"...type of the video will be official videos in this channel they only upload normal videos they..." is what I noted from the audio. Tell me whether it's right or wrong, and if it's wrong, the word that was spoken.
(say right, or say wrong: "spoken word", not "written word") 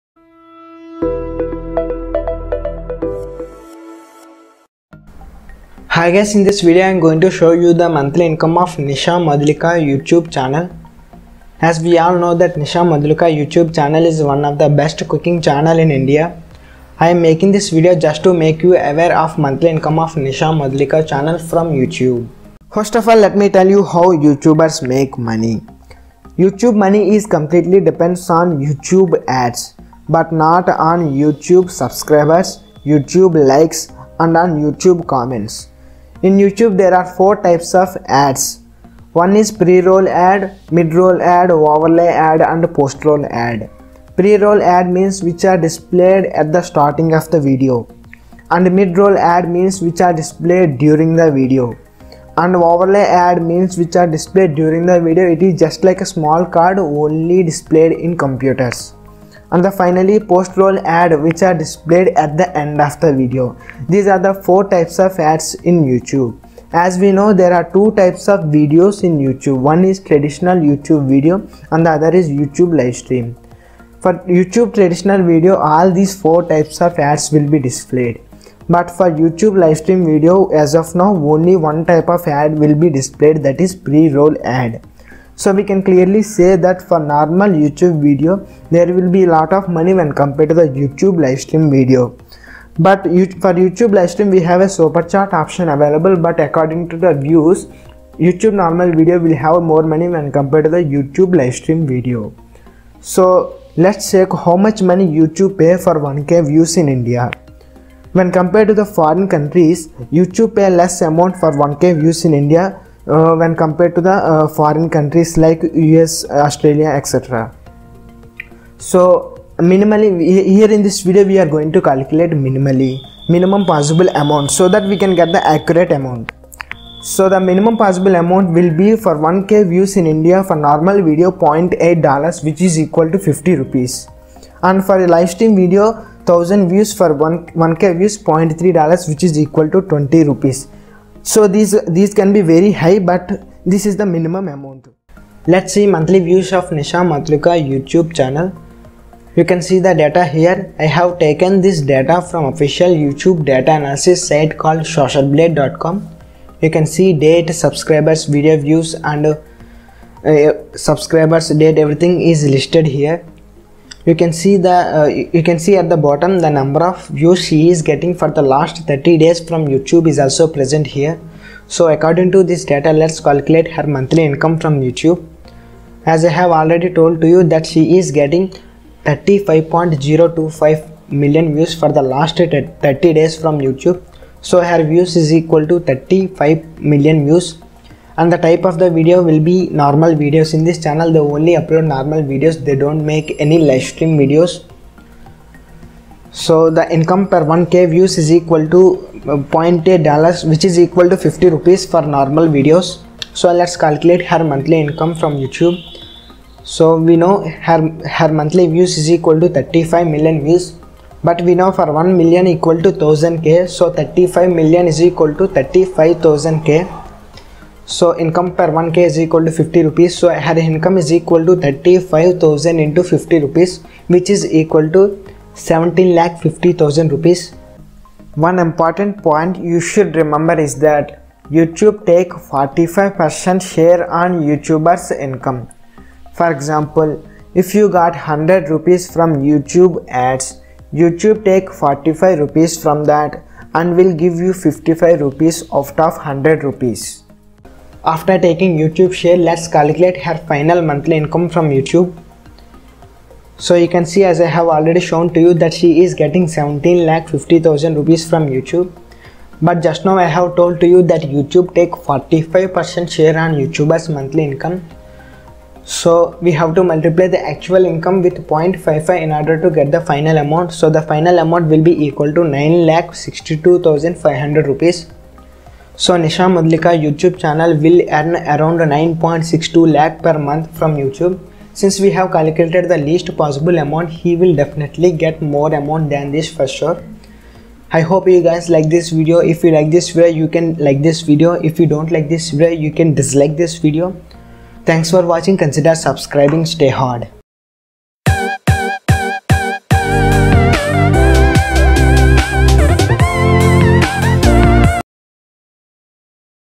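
wrong: "normal", not "official".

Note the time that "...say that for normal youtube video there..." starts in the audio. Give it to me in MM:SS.
01:26.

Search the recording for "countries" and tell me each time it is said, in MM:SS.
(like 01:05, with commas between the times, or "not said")
01:49, 01:54.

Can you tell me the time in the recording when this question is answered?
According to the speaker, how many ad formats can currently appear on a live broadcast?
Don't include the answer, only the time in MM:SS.
01:21.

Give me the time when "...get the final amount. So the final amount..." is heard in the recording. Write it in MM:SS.
04:29.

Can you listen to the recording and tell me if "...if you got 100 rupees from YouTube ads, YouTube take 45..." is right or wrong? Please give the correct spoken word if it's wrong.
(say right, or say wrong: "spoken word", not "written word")
right.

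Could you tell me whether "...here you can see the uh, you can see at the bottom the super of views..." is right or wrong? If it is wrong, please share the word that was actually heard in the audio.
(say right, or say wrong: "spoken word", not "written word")
wrong: "number", not "super".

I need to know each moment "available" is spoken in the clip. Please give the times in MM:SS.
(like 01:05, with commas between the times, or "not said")
01:35.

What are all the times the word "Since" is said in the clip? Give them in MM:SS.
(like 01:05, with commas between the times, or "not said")
04:41.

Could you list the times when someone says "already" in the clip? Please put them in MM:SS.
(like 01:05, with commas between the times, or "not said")
02:56, 04:14.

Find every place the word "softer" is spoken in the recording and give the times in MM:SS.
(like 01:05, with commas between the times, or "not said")
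not said.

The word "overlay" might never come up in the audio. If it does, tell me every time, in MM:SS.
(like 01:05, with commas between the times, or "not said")
00:41, 00:52.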